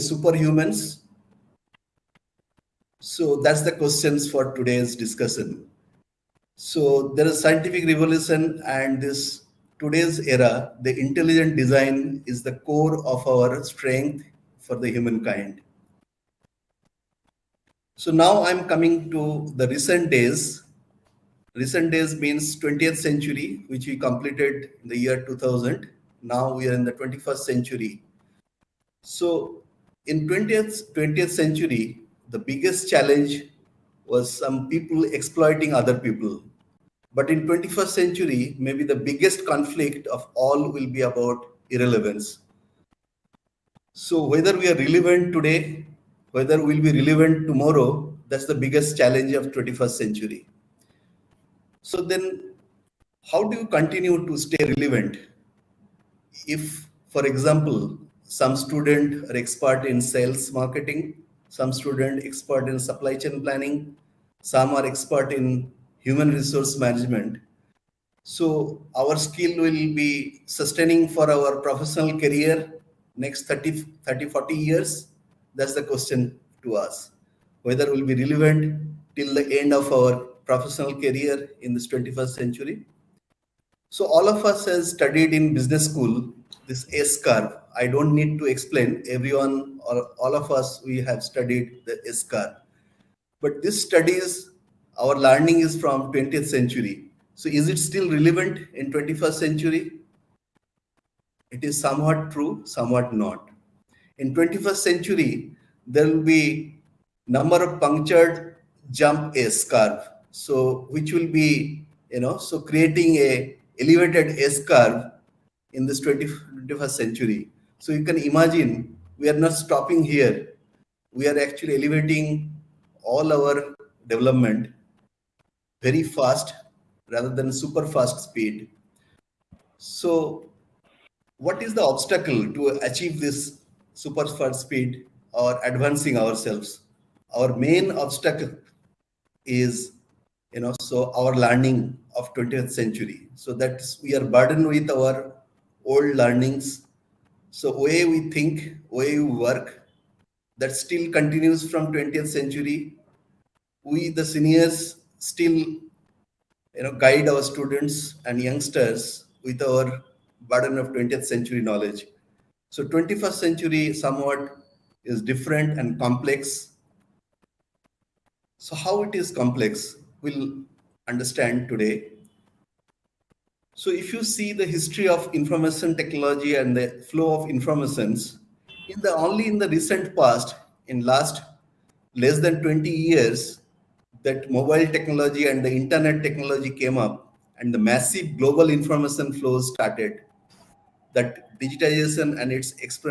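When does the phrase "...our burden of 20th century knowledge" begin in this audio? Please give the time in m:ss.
2:39.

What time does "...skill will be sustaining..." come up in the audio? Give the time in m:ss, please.
1:09.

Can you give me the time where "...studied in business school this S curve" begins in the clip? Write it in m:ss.
1:24.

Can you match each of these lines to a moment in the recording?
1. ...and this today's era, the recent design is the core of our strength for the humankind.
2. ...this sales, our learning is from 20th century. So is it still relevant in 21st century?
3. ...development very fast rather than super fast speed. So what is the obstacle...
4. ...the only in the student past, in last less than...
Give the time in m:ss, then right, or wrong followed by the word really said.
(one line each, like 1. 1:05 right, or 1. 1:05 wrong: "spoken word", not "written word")
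1. 0:08 wrong: "intelligent", not "recent"
2. 1:33 wrong: "studies", not "sales"
3. 2:04 right
4. 2:59 wrong: "recent", not "student".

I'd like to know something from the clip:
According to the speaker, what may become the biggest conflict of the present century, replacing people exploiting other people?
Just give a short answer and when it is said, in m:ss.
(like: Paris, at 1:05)
Irrelevance, at 0:41.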